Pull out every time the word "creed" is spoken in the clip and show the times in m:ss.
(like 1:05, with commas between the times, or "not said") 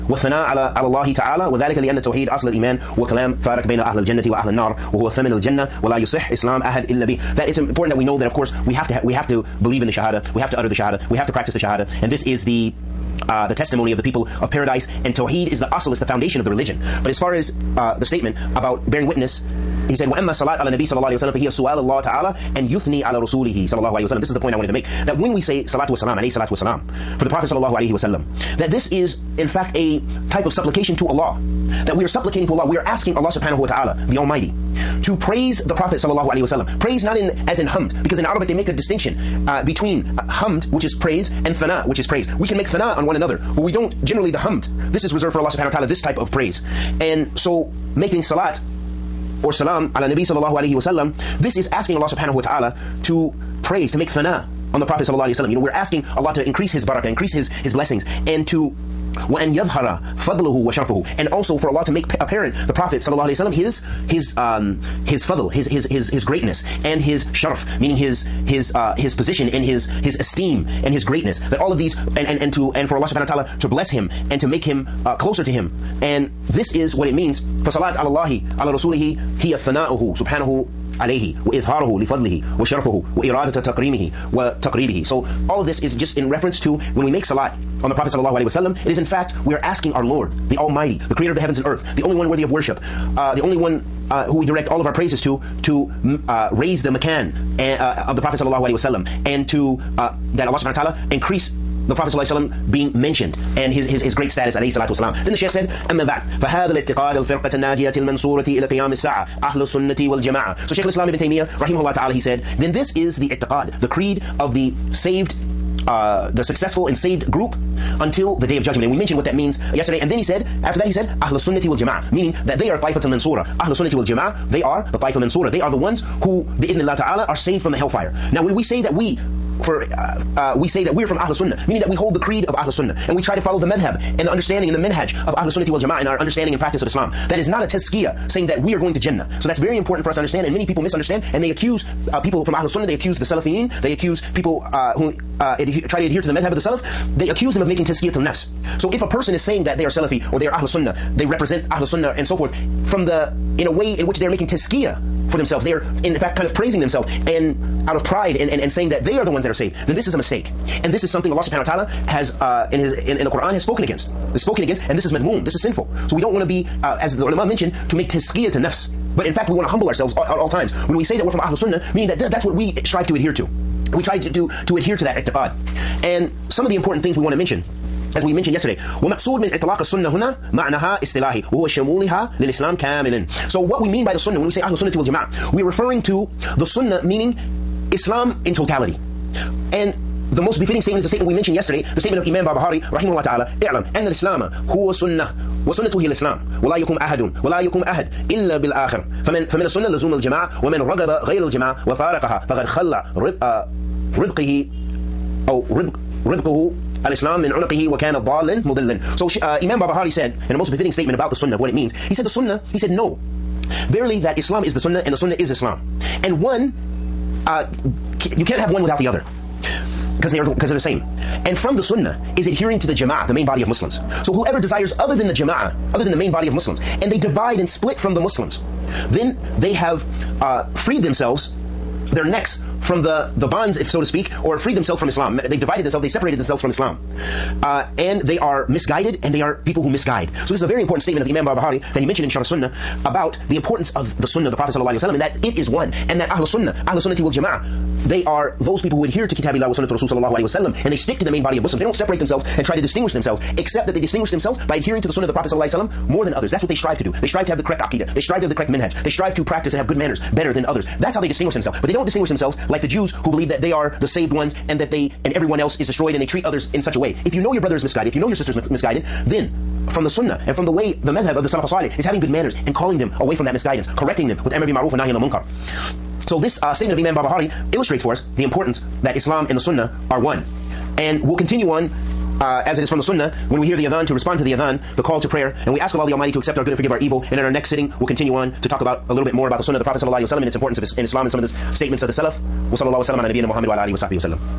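1:53, 2:12.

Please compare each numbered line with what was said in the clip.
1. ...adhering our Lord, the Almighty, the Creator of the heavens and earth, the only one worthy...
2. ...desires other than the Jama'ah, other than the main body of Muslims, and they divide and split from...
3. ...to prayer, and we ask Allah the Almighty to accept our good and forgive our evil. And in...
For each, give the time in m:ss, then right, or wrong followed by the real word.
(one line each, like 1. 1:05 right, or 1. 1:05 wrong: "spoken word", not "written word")
1. 1:29 wrong: "asking", not "adhering"
2. 3:44 right
3. 4:45 right.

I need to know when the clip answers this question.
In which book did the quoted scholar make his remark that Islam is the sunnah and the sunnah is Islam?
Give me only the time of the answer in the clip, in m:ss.
4:02.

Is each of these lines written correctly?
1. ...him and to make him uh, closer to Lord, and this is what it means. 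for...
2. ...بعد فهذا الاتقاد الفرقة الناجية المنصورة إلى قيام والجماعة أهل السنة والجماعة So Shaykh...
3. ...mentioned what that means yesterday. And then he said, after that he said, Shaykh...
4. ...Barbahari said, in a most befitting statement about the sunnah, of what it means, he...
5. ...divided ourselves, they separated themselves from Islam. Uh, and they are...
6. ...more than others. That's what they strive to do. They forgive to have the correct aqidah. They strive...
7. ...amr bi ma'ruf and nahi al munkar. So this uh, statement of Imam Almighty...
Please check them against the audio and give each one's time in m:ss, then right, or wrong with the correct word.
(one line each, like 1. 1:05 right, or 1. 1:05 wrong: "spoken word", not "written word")
1. 1:13 wrong: "Him", not "Lord"
2. 1:46 wrong: "الساعة", not "والجماعة"
3. 1:58 wrong: "Ahl", not "Shaykh"
4. 3:29 right
5. 3:55 wrong: "themselves", not "ourselves"
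6. 4:16 wrong: "strive", not "forgive"
7. 4:34 wrong: "Barbahari", not "Almighty".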